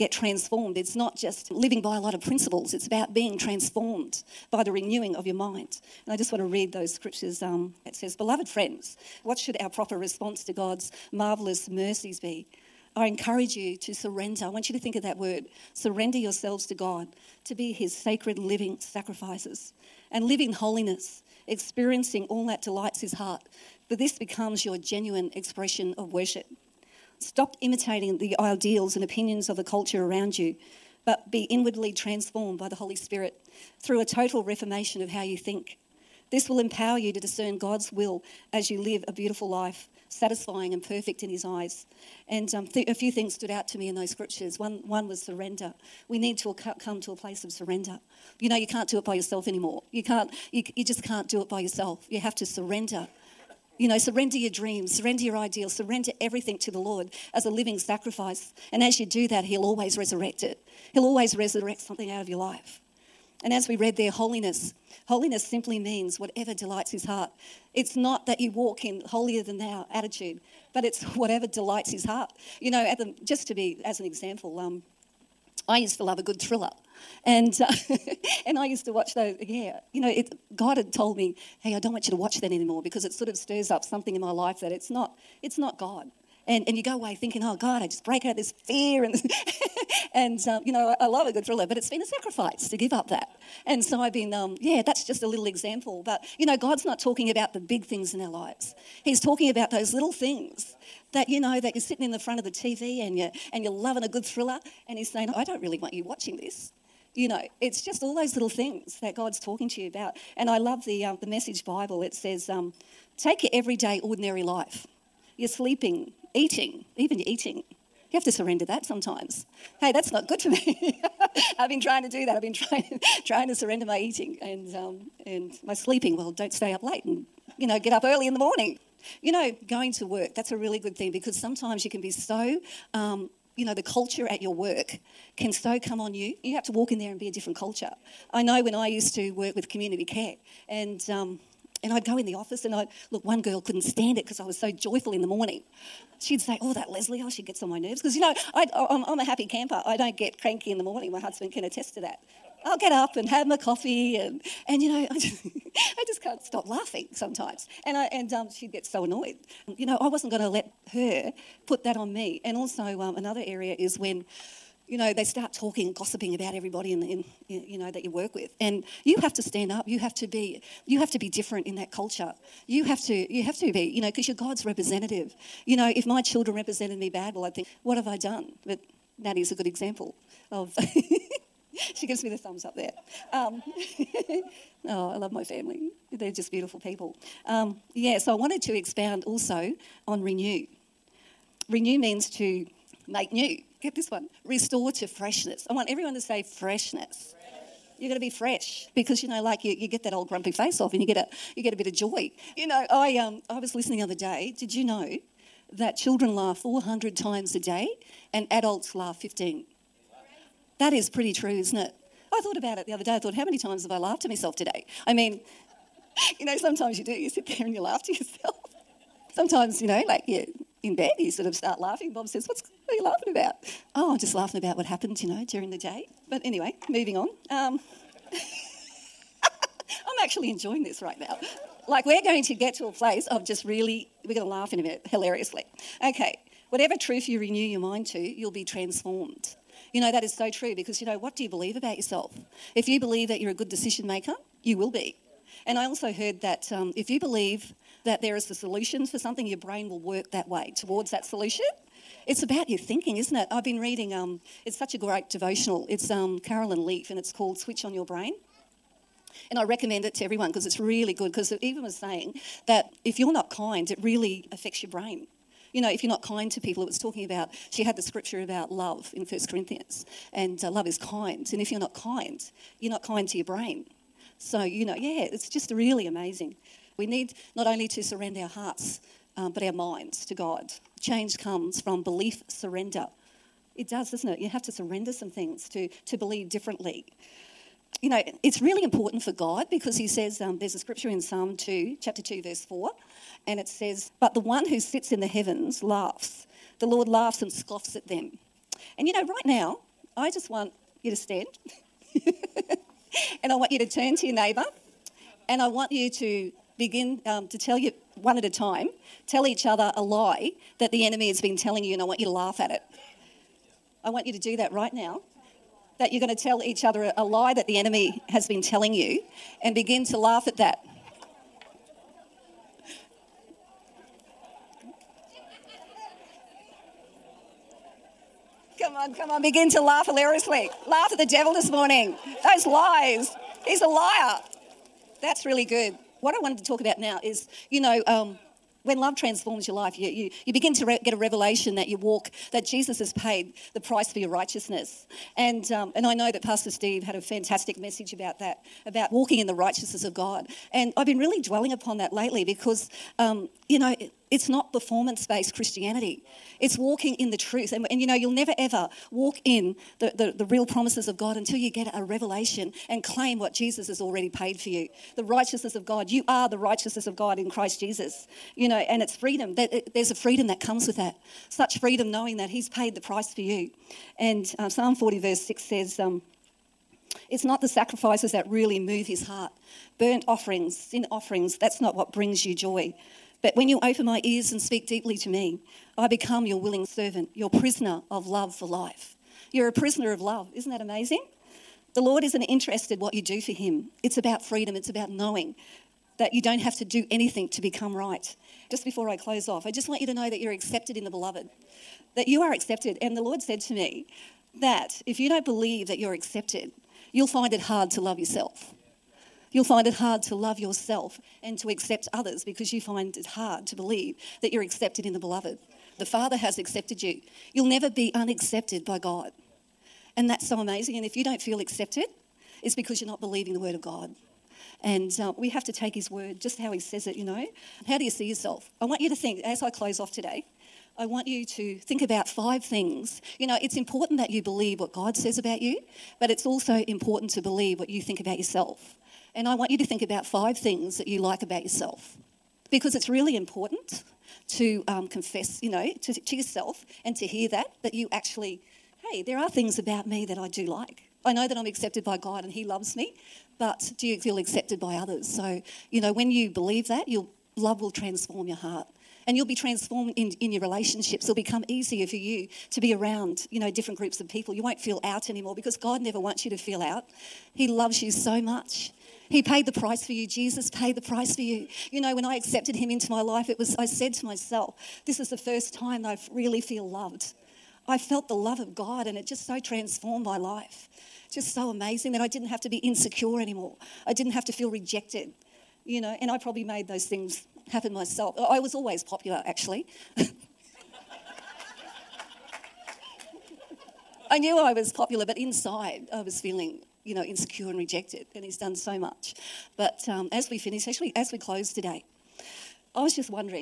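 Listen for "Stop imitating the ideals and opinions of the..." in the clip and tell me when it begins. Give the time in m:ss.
0:27.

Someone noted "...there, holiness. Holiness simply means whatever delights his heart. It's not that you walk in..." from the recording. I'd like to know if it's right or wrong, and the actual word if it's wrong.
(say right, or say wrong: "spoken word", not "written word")
right.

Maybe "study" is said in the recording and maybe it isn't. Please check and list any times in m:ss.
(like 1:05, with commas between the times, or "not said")
not said.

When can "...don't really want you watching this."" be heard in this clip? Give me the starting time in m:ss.
1:45.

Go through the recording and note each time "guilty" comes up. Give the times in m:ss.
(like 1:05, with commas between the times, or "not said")
not said.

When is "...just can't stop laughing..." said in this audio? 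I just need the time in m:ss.
2:36.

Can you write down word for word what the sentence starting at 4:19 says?
And I recommend it to everyone because it's really good.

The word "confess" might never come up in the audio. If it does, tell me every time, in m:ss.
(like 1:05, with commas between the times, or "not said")
7:25.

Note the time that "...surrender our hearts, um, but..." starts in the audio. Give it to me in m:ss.
4:38.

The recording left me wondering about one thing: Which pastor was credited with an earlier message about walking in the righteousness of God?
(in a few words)
Pastor Steve.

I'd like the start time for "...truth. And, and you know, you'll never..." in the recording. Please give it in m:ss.
5:57.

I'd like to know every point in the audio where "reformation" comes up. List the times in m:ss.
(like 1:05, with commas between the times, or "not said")
0:34.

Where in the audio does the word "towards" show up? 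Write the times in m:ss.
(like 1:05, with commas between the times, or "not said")
4:10.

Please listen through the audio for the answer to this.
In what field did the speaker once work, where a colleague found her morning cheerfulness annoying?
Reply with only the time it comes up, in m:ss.
2:19.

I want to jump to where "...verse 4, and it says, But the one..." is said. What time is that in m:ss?
4:52.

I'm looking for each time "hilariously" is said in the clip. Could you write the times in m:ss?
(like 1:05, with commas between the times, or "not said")
3:55, 5:30.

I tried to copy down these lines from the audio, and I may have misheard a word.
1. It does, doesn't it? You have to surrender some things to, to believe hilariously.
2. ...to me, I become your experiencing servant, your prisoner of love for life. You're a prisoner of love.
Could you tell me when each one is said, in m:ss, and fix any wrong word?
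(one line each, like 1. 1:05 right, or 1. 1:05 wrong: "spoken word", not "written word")
1. 4:43 wrong: "differently", not "hilariously"
2. 6:25 wrong: "willing", not "experiencing".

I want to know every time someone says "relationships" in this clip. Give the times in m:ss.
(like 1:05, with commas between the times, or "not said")
7:40.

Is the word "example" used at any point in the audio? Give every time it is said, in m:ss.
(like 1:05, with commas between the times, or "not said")
1:14, 1:35, 2:59.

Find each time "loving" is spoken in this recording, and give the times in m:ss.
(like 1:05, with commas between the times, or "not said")
1:43.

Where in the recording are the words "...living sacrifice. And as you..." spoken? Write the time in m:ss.
0:57.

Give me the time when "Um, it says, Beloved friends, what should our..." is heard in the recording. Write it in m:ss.
0:07.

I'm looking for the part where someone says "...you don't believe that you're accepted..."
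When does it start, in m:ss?
6:45.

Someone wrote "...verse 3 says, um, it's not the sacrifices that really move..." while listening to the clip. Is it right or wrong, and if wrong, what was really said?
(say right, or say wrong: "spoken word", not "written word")
wrong: "6", not "3".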